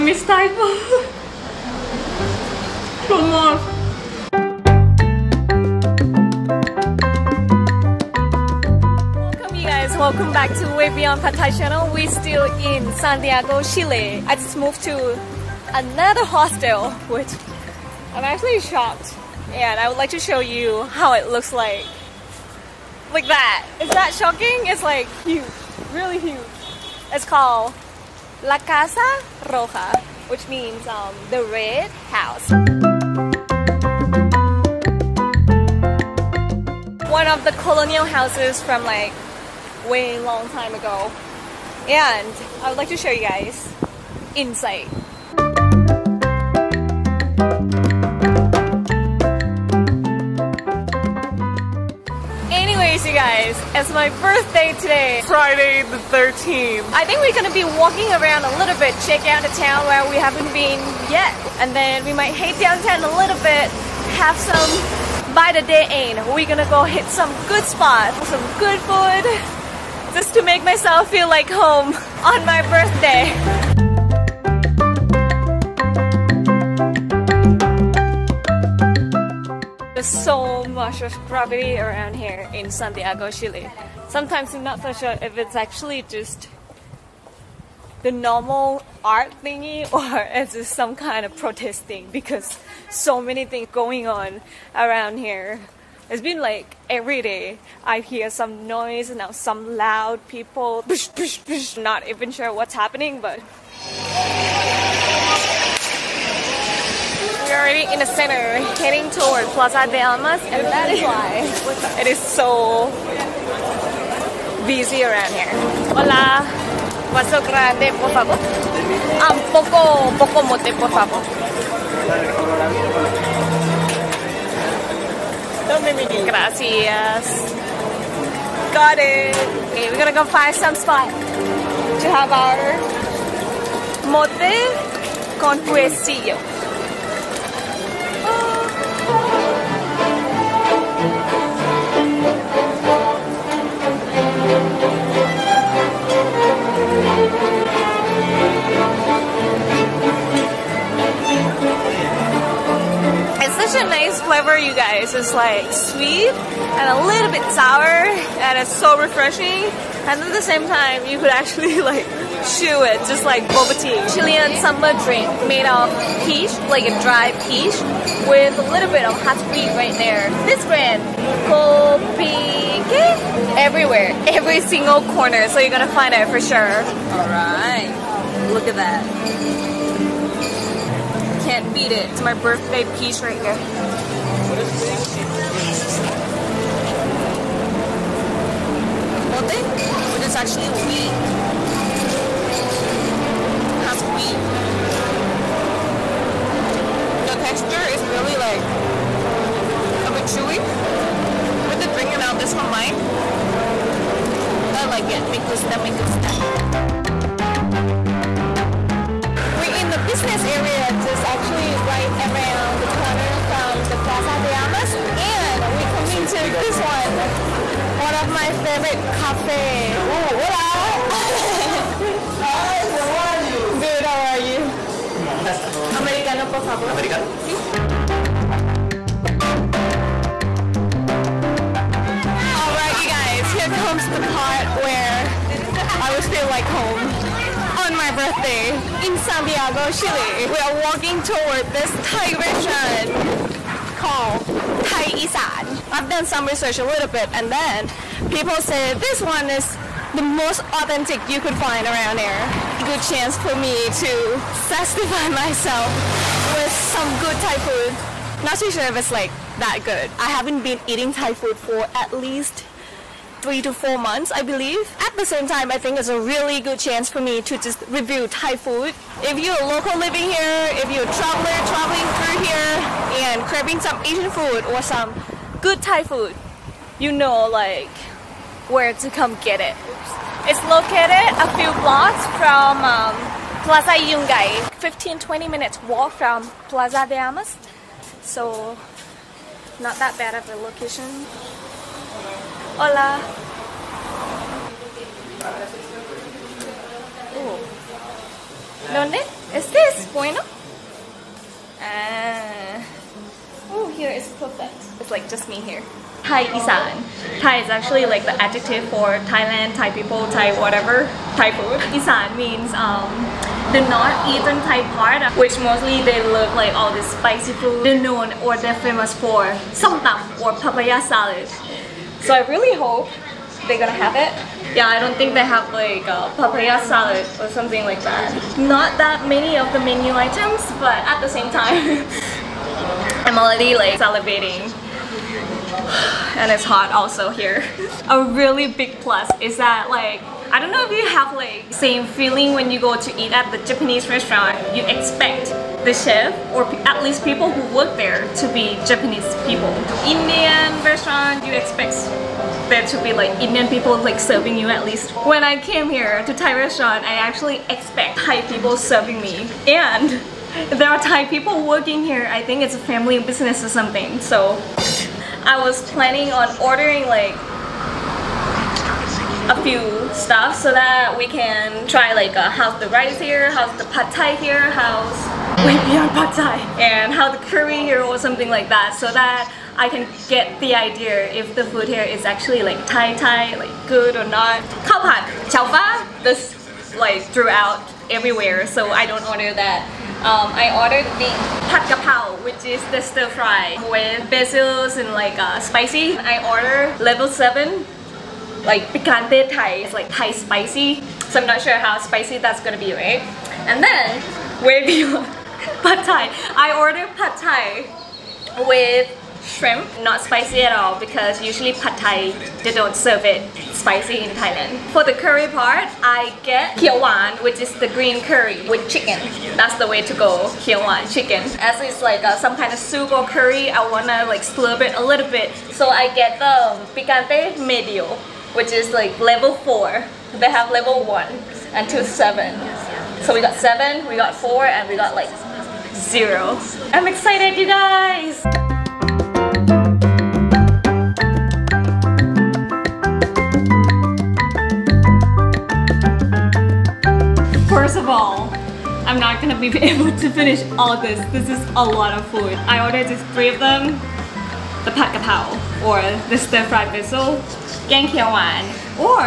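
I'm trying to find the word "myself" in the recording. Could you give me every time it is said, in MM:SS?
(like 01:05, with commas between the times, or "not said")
01:10, 04:15.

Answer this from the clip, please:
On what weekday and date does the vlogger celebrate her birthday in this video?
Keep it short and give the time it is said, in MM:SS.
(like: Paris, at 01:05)
Friday the 13th, at 00:55.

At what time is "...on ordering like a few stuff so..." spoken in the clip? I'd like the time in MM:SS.
06:06.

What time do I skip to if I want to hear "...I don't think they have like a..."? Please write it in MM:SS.
05:24.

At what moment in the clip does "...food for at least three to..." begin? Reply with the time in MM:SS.
04:21.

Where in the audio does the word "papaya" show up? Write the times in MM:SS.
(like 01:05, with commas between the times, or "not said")
05:20, 05:26.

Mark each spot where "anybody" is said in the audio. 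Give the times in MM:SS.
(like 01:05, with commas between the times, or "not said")
not said.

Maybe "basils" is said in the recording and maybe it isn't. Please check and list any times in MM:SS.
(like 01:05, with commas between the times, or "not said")
06:34, 07:36.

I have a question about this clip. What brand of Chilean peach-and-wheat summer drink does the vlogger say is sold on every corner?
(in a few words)
Copique.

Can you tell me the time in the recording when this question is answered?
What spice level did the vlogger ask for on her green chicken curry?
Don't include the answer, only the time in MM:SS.
07:09.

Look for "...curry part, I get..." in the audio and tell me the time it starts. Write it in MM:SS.
06:55.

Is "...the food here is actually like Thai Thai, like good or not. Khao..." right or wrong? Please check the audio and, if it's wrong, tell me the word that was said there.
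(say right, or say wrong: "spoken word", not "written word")
right.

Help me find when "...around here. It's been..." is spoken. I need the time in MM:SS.
01:34.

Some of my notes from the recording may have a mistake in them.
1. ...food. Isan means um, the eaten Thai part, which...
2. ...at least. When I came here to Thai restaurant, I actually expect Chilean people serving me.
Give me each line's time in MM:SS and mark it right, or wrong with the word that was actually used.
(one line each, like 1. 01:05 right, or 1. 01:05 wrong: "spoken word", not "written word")
1. 05:11 right
2. 05:54 wrong: "Thai", not "Chilean".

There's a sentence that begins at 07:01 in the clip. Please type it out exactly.
As it's like uh, some kind of soup or curry, I wanna like slurp it a little bit.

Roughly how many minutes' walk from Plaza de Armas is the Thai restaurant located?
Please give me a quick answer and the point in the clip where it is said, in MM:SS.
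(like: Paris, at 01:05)
15-20 minutes, at 04:44.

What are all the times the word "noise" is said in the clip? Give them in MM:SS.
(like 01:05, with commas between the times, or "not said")
01:38.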